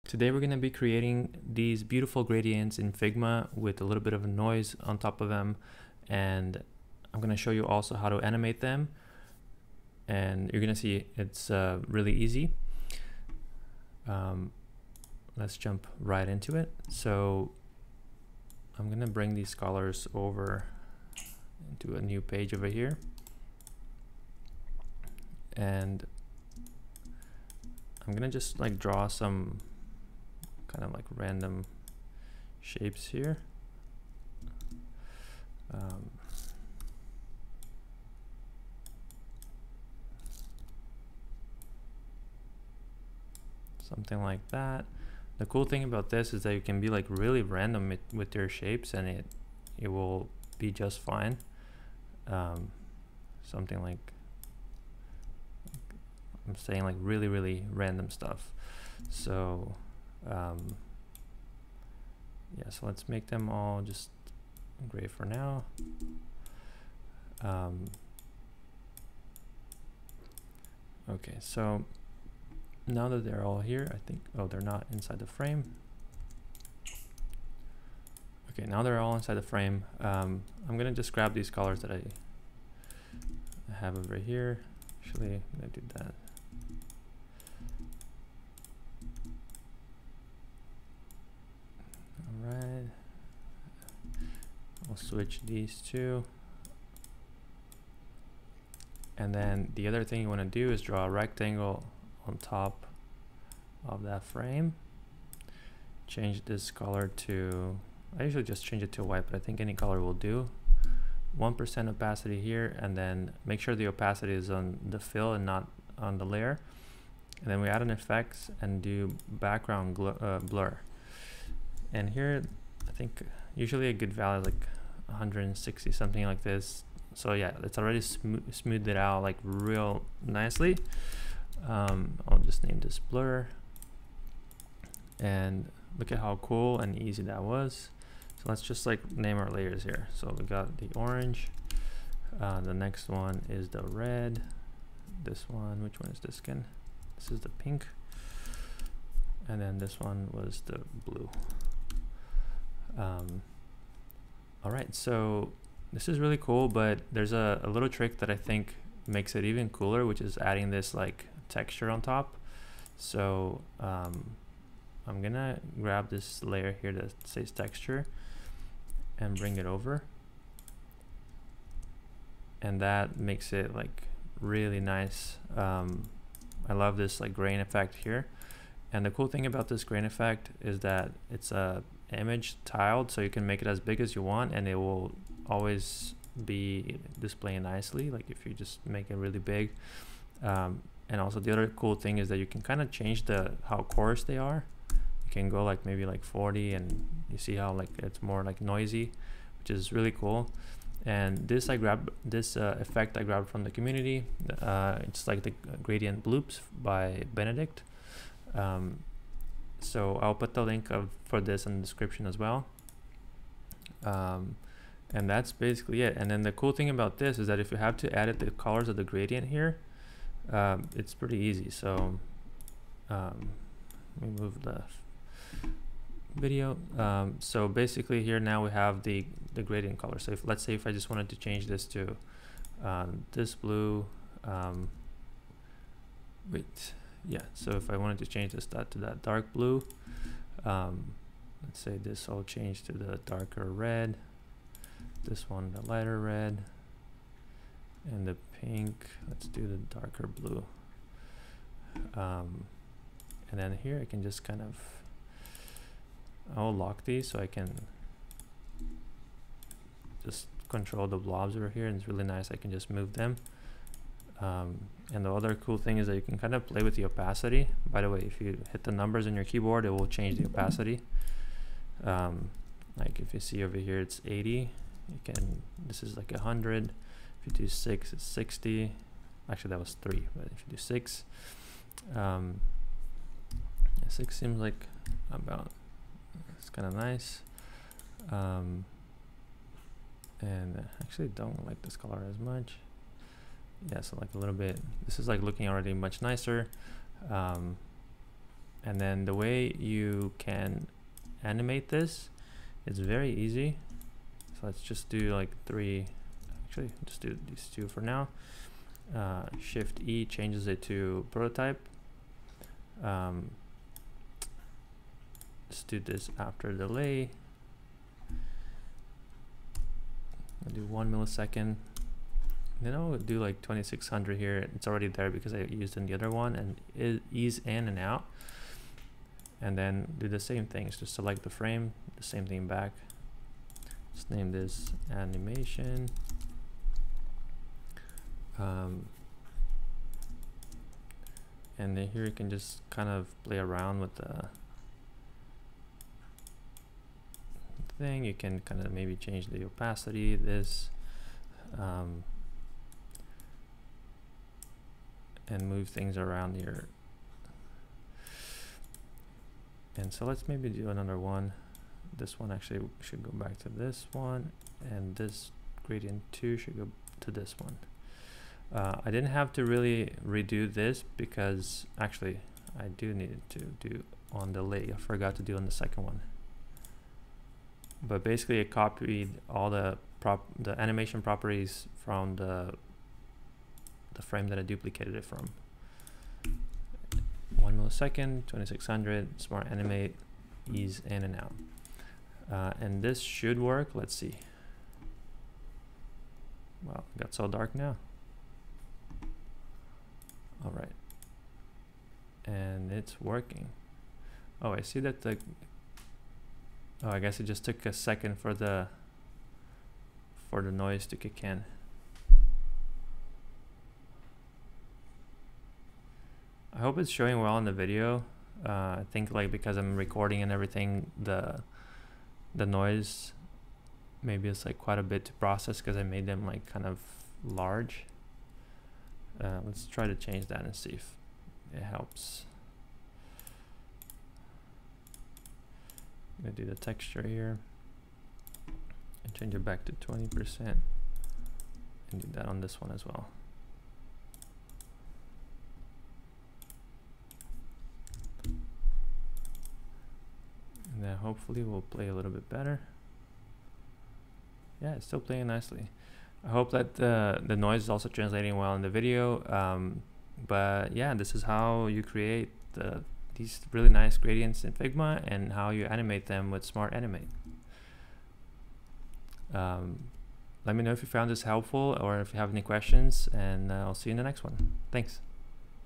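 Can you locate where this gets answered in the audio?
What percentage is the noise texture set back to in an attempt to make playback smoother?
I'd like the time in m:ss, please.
7:19.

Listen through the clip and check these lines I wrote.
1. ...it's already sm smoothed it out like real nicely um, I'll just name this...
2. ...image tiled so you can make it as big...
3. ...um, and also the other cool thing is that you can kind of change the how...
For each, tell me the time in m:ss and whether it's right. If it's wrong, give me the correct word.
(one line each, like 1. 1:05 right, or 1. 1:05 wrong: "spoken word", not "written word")
1. 2:07 right
2. 3:02 right
3. 3:10 right.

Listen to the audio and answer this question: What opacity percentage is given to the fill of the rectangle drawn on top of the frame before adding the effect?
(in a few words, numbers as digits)
1%.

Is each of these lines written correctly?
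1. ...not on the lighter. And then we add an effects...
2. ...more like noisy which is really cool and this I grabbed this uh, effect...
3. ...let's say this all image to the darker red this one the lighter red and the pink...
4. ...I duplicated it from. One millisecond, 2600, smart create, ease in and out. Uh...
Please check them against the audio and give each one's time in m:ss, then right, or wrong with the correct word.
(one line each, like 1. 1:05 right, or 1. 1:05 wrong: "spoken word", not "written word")
1. 1:55 wrong: "layer", not "lighter"
2. 3:18 right
3. 4:01 wrong: "change", not "image"
4. 6:24 wrong: "animate", not "create".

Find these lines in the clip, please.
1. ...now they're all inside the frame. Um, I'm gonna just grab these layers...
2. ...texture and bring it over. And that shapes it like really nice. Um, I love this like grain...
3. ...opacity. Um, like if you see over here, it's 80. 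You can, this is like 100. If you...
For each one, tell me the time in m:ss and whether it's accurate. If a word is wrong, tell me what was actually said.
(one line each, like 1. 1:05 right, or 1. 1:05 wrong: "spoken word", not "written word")
1. 1:18 wrong: "colors", not "layers"
2. 2:47 wrong: "makes", not "shapes"
3. 4:30 right.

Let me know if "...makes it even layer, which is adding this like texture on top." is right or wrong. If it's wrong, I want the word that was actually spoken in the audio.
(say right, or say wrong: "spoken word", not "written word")
wrong: "cooler", not "layer".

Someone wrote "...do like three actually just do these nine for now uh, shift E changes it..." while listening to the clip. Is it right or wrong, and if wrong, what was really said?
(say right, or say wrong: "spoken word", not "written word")
wrong: "two", not "nine".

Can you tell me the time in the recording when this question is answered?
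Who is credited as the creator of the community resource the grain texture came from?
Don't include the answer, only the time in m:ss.
3:27.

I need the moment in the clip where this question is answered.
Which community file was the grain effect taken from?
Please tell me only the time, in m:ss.
3:25.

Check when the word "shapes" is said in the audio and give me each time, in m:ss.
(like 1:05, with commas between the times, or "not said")
0:32, 0:48.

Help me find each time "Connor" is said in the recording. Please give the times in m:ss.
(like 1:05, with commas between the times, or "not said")
not said.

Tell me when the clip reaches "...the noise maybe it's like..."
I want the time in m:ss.
7:02.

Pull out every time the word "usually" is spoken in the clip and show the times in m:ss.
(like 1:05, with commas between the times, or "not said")
1:48, 2:03.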